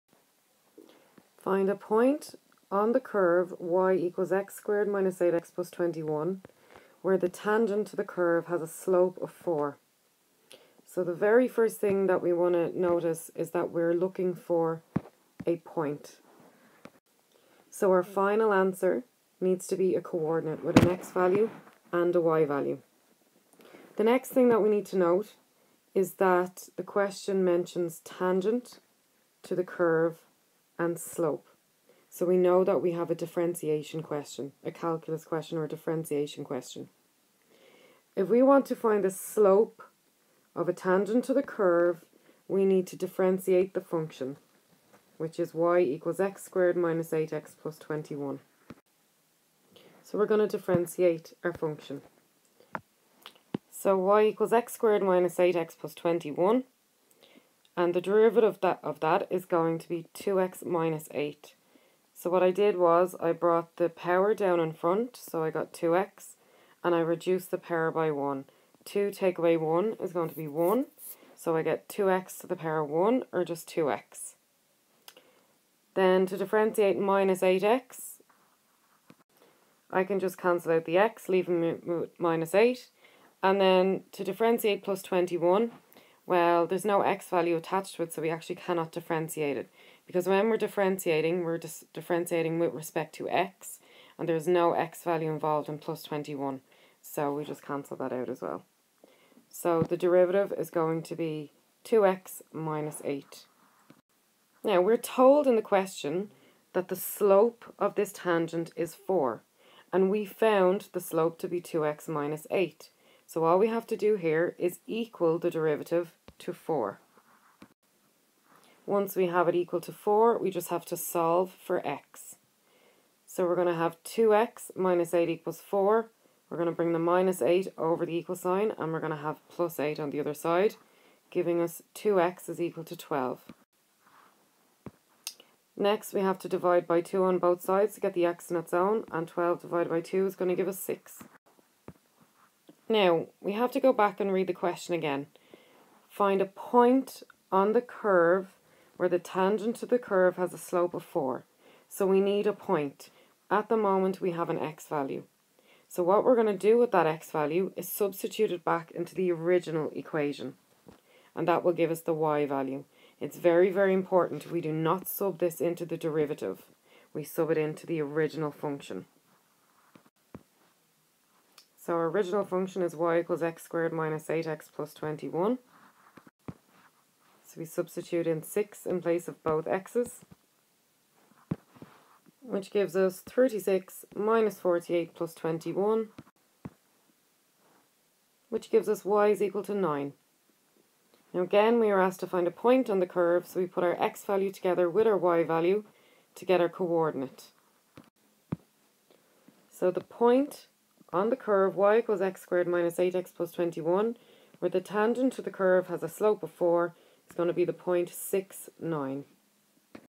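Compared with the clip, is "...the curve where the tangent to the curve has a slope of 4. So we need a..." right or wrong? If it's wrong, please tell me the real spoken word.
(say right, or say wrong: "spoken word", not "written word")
right.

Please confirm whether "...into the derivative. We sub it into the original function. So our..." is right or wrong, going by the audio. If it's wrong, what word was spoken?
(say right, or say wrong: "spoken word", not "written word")
right.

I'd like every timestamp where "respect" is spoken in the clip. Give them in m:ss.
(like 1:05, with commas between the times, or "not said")
1:32.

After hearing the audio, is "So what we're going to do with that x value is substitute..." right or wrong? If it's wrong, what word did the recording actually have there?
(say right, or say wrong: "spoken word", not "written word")
right.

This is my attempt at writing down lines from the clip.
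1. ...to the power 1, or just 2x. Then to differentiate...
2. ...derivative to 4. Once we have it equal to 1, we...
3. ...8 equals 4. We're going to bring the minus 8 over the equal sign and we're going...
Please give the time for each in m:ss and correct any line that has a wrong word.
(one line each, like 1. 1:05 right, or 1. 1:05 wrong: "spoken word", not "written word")
1. 1:12 right
2. 1:55 wrong: "4", not "1"
3. 2:05 right.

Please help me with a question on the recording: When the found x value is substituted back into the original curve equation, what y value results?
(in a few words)
9.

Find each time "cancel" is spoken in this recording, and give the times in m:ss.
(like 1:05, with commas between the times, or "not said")
1:20, 1:37.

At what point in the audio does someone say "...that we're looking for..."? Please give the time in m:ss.
0:13.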